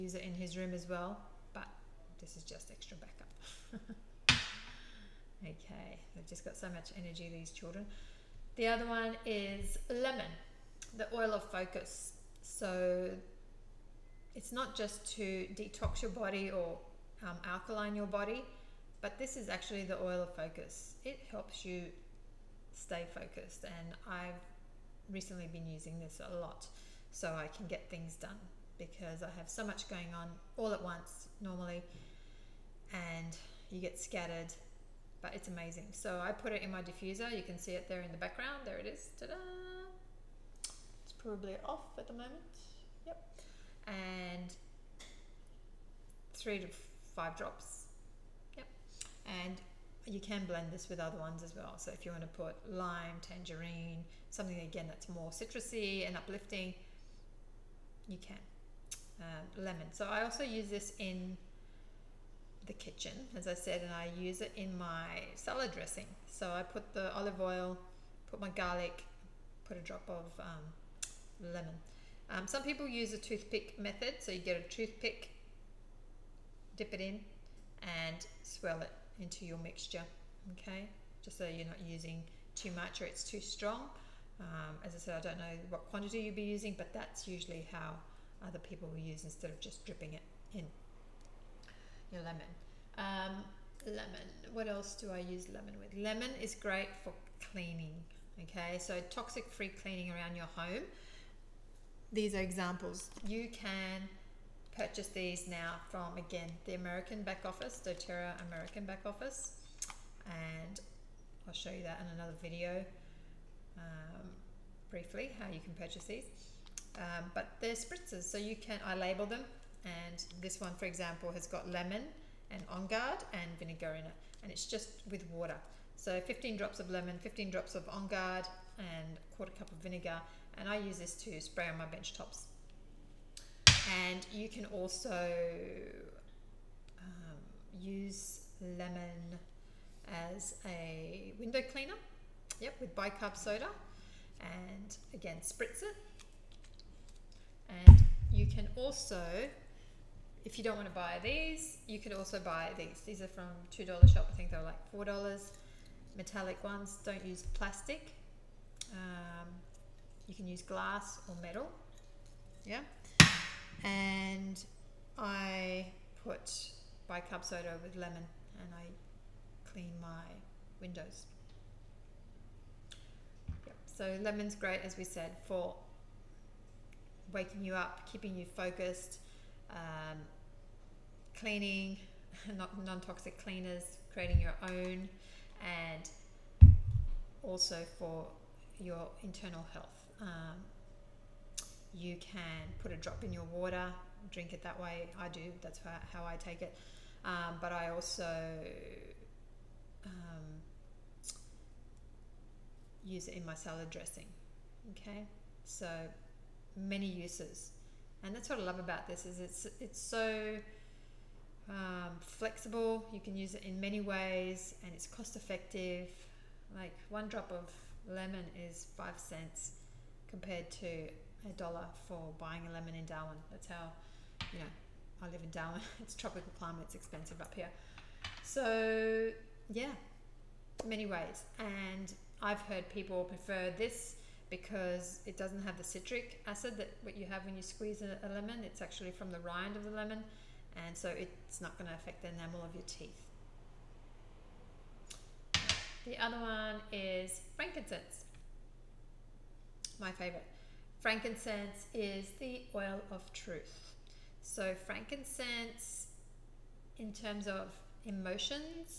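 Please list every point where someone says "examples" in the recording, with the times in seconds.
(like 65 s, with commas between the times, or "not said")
102 s, 120 s.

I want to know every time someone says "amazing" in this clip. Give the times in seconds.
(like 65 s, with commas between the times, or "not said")
35 s.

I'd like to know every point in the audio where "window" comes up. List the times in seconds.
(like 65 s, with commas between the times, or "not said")
141 s, 170 s.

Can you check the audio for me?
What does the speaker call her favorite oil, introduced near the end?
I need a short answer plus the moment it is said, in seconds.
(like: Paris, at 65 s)
truth, at 253 s.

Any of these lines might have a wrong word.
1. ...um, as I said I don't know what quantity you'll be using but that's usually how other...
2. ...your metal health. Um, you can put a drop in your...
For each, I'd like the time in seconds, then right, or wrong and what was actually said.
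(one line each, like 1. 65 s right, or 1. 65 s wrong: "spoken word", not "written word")
1. 84 s right
2. 188 s wrong: "internal", not "metal".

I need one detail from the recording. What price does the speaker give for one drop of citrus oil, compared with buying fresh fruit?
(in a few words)
5 cents.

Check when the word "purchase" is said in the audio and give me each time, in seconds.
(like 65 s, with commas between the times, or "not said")
104 s, 115 s.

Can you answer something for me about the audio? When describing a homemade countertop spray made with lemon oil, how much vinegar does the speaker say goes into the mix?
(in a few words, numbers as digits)
a quarter cup.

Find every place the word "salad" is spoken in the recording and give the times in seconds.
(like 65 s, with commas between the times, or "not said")
65 s, 203 s.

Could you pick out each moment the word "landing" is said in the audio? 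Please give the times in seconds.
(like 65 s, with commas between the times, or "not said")
not said.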